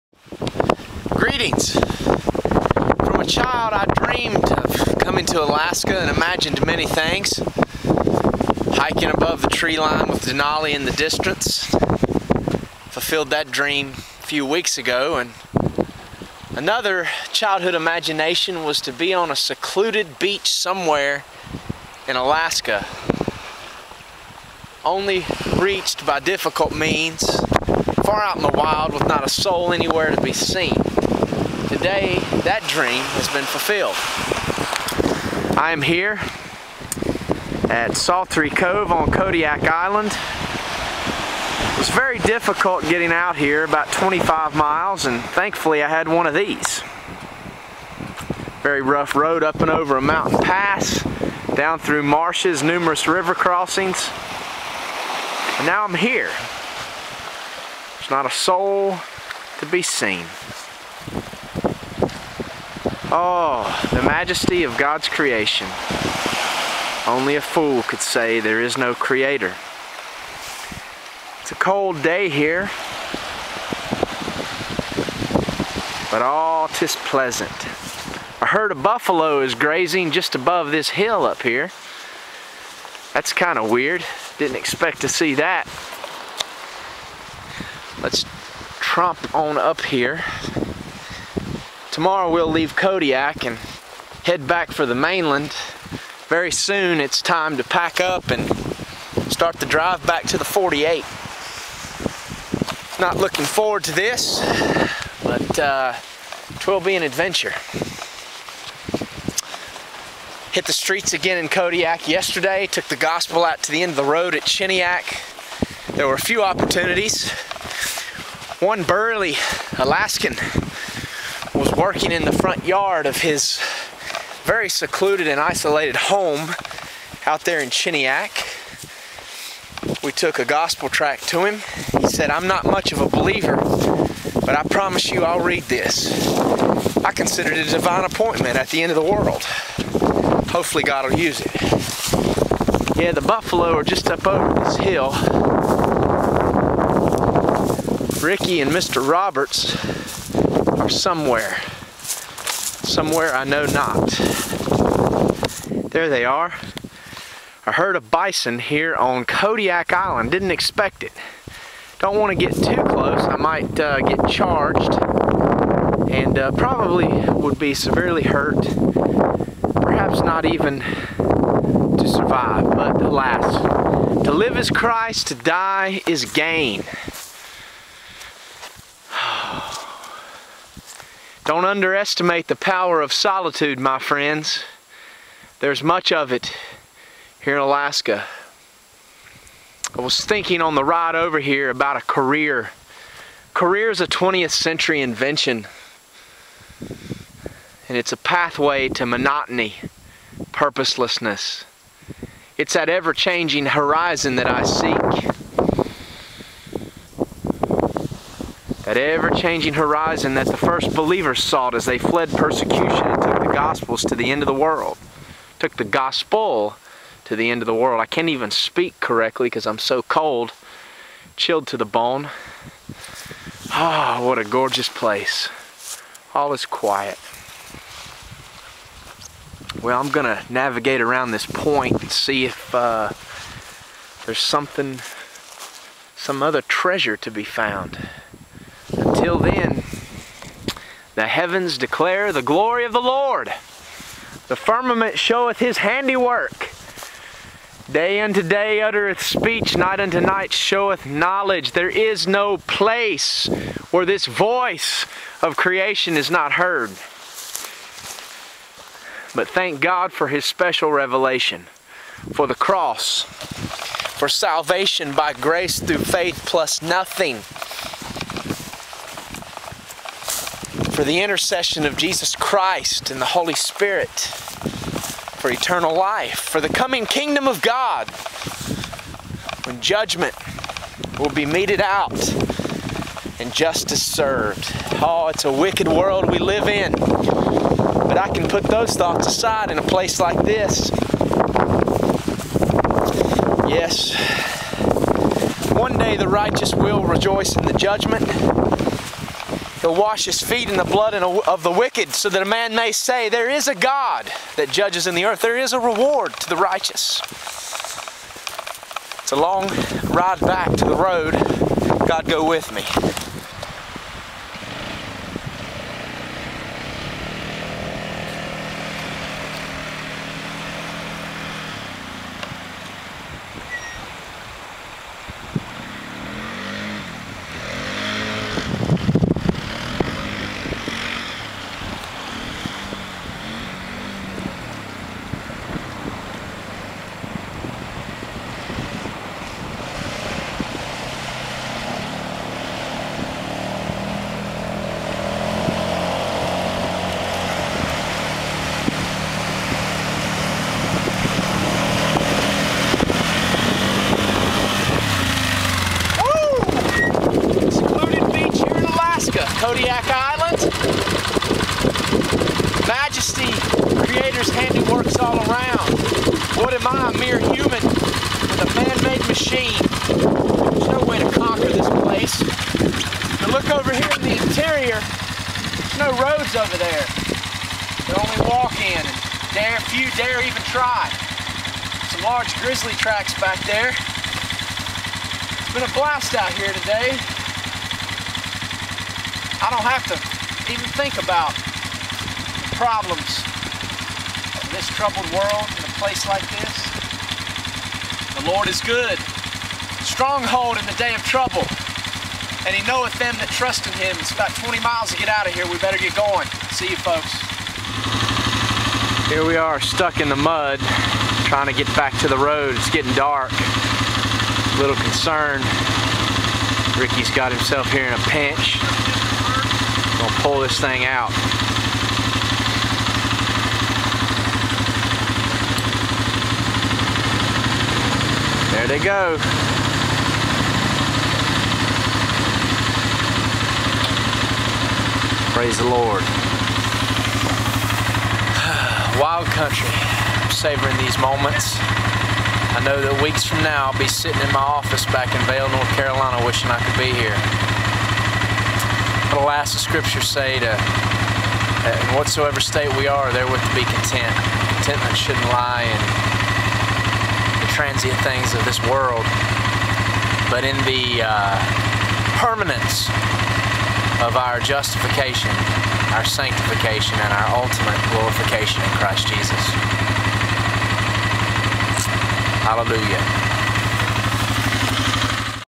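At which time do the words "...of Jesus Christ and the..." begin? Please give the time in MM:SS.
04:31.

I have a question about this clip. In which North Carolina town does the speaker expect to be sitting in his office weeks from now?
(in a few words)
Vale.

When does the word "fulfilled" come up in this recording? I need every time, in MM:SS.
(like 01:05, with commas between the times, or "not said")
00:12, 00:33.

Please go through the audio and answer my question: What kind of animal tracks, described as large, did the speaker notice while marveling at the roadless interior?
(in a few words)
Grizzly.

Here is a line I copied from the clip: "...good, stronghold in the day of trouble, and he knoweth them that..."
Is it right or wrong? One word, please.
right.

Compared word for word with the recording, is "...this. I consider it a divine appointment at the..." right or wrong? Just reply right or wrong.
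right.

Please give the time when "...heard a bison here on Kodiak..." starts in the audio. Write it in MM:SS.
02:37.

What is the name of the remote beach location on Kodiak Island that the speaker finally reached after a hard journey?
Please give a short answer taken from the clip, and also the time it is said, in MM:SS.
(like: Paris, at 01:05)
Saltery Cove, at 00:37.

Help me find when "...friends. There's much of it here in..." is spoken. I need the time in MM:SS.
03:03.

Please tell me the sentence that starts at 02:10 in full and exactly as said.
We took a gospel tract to him.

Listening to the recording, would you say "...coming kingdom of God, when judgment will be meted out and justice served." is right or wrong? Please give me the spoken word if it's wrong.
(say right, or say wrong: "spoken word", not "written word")
right.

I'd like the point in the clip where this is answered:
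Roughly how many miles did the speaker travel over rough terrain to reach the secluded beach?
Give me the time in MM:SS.
00:43.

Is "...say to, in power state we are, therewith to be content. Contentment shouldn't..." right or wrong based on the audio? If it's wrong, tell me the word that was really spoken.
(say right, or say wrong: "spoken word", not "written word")
wrong: "whatsoever", not "power".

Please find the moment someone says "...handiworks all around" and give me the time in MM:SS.
06:04.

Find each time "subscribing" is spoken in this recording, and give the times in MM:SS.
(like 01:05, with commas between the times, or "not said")
not said.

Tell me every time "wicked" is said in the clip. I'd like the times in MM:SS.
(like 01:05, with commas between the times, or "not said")
04:45, 05:01.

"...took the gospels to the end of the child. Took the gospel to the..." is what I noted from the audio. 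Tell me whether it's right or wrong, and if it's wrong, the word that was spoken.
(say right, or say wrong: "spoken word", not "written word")
wrong: "world", not "child".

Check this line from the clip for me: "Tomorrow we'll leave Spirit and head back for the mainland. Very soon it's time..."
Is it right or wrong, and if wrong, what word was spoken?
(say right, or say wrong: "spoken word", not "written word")
wrong: "Kodiak", not "Spirit".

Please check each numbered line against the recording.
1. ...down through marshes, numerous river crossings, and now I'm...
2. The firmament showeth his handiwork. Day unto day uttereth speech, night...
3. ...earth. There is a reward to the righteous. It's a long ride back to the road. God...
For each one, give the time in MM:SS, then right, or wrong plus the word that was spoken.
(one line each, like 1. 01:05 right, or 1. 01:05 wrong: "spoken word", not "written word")
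1. 00:51 right
2. 04:04 right
3. 05:05 right.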